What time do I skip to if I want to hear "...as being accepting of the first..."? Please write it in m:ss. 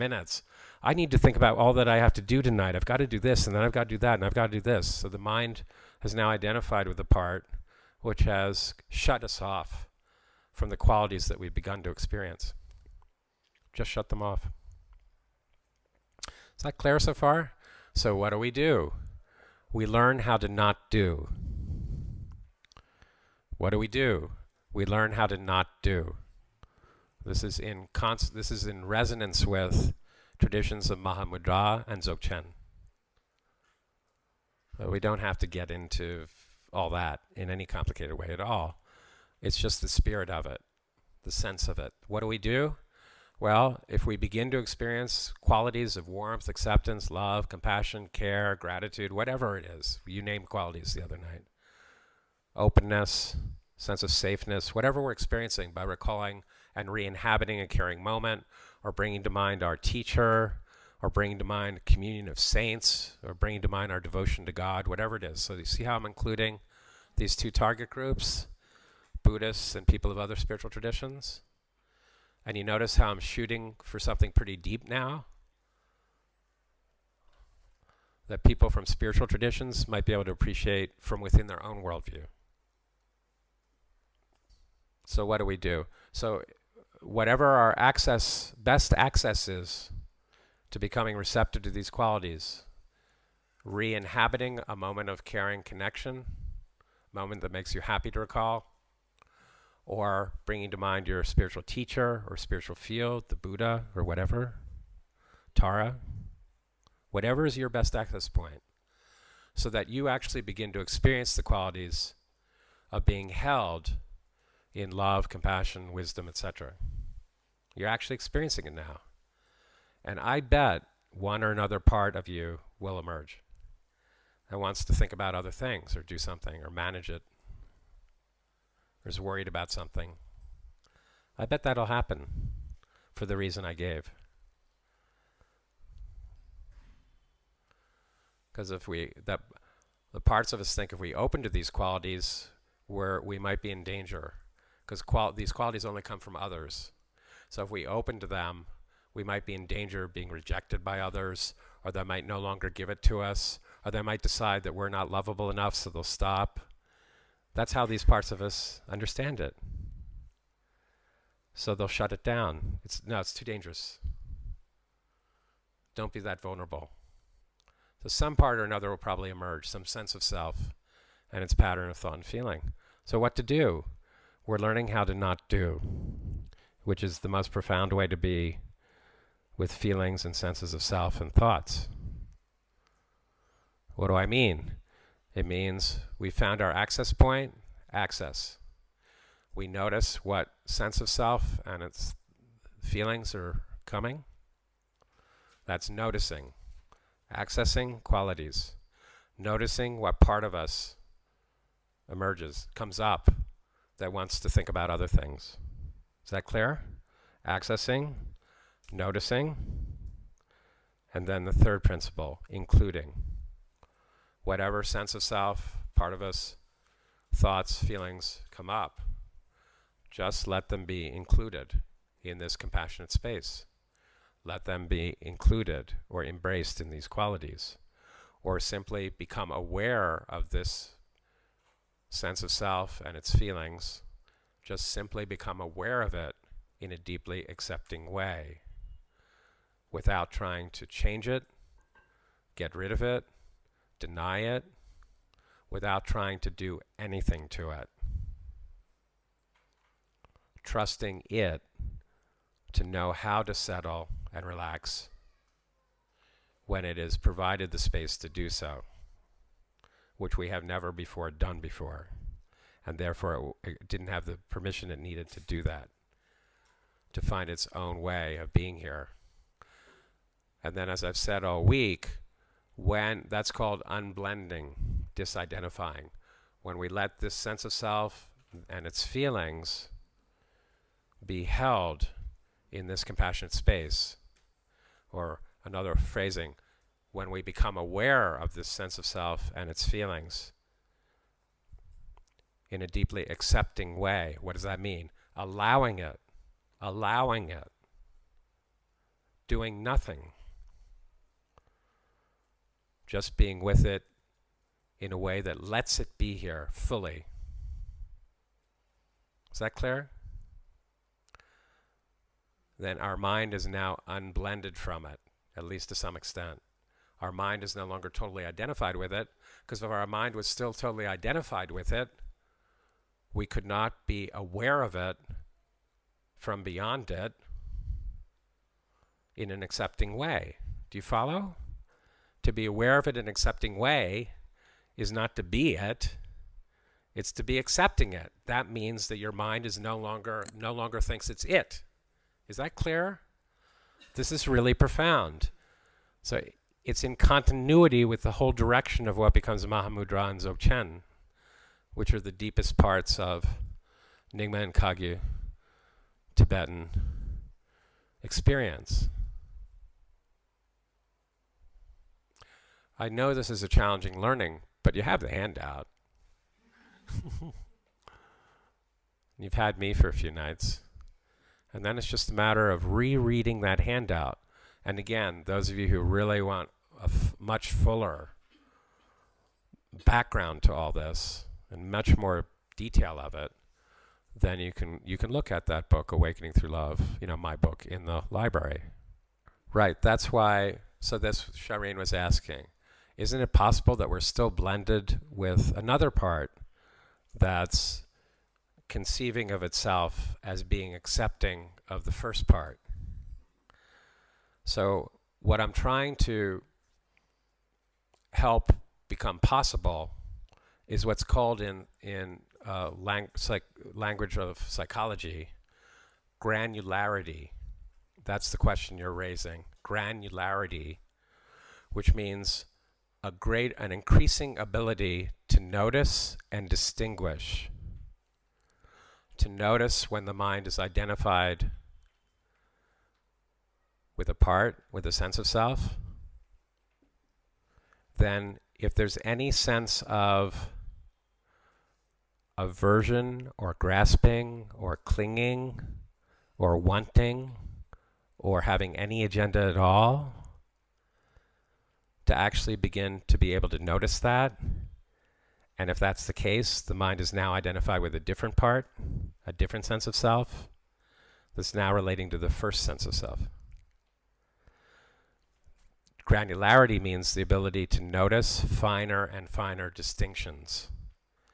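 6:40.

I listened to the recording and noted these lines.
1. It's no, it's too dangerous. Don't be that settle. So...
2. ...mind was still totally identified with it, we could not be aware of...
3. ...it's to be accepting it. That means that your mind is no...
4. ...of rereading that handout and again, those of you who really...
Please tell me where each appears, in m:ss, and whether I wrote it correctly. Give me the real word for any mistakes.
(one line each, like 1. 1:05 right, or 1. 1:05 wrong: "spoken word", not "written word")
1. 2:42 wrong: "vulnerable", not "settle"
2. 5:20 right
3. 5:37 right
4. 6:12 right.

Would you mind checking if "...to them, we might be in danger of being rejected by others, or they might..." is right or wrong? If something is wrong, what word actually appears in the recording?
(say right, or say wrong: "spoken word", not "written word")
right.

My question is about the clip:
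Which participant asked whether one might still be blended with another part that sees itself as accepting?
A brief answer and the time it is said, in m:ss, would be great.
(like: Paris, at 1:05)
Shireen, at 6:31.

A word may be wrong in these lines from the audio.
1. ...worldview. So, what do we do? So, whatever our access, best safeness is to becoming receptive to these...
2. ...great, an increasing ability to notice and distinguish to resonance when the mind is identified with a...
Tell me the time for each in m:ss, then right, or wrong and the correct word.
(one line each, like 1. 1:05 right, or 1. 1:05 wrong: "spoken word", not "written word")
1. 1:21 wrong: "access", not "safeness"
2. 7:03 wrong: "notice", not "resonance".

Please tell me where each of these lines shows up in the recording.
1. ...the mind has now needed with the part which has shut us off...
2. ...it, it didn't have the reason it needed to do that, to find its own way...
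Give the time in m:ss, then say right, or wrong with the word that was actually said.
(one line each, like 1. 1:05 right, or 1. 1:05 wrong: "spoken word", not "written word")
1. 0:05 wrong: "identified", not "needed"
2. 4:23 wrong: "permission", not "reason".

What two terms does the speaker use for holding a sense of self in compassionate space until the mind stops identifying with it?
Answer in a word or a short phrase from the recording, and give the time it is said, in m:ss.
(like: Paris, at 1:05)
Unblending, disidentifying, at 4:33.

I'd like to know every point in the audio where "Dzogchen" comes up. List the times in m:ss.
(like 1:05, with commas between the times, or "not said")
0:32, 5:50.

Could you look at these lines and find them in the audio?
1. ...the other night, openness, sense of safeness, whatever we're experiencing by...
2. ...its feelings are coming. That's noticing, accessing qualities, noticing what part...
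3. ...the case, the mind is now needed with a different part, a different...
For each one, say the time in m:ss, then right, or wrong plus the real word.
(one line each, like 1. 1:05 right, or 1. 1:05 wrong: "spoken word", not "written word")
1. 0:50 right
2. 3:11 right
3. 7:36 wrong: "identified", not "needed".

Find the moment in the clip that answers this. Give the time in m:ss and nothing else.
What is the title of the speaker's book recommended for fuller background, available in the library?
6:26.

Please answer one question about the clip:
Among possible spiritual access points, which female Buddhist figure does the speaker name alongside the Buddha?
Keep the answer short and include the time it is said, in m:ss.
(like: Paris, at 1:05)
Tara, at 1:45.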